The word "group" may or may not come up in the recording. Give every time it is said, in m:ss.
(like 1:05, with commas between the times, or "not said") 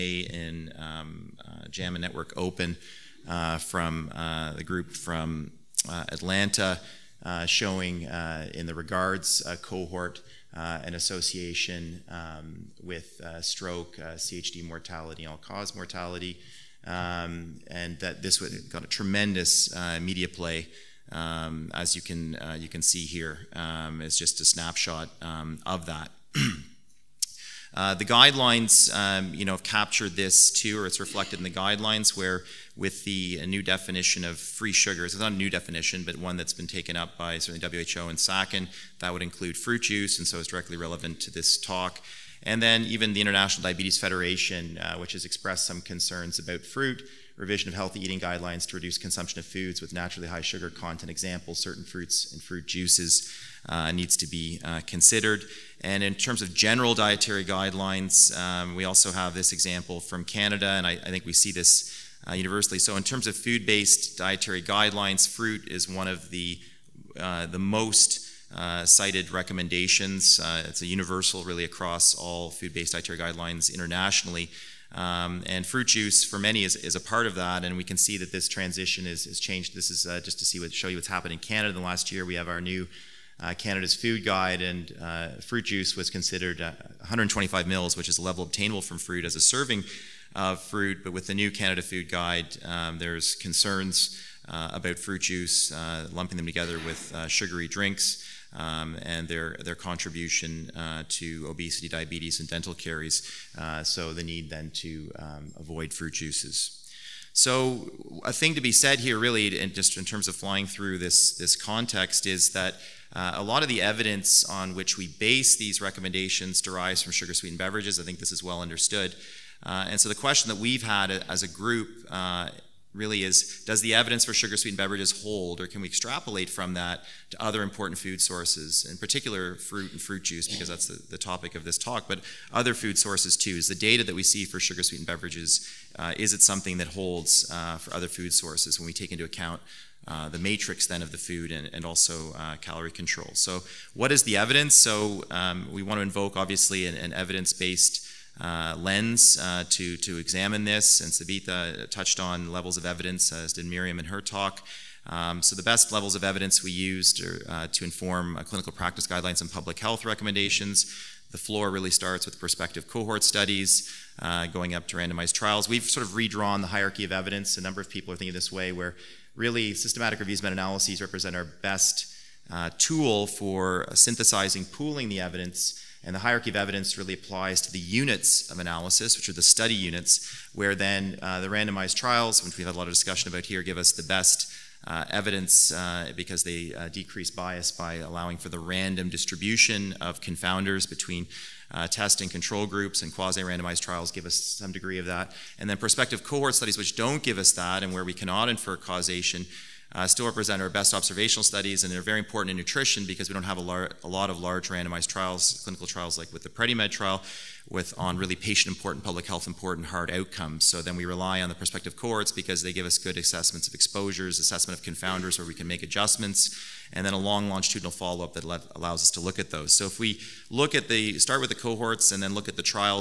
0:04, 2:01, 3:12.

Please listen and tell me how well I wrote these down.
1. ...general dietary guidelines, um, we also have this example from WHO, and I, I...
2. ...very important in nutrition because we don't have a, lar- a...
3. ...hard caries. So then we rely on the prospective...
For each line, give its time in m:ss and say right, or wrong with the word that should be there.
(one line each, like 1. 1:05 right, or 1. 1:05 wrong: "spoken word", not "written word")
1. 0:56 wrong: "Canada", not "WHO"
2. 3:22 right
3. 3:29 wrong: "outcomes", not "caries".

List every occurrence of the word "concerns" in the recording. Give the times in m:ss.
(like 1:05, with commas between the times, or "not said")
0:45, 1:33.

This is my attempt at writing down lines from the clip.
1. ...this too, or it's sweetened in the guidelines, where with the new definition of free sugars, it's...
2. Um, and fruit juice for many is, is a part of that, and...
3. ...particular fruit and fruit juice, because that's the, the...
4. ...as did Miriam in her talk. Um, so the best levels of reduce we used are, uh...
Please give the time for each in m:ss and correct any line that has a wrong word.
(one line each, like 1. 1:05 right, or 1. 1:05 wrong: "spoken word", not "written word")
1. 0:30 wrong: "reflected", not "sweetened"
2. 1:14 right
3. 2:08 right
4. 2:33 wrong: "evidence", not "reduce".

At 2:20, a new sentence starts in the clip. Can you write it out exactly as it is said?
Uh, the matrix then of the food and, and also uh, calorie control.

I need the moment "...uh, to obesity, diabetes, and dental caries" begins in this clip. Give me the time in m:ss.
1:40.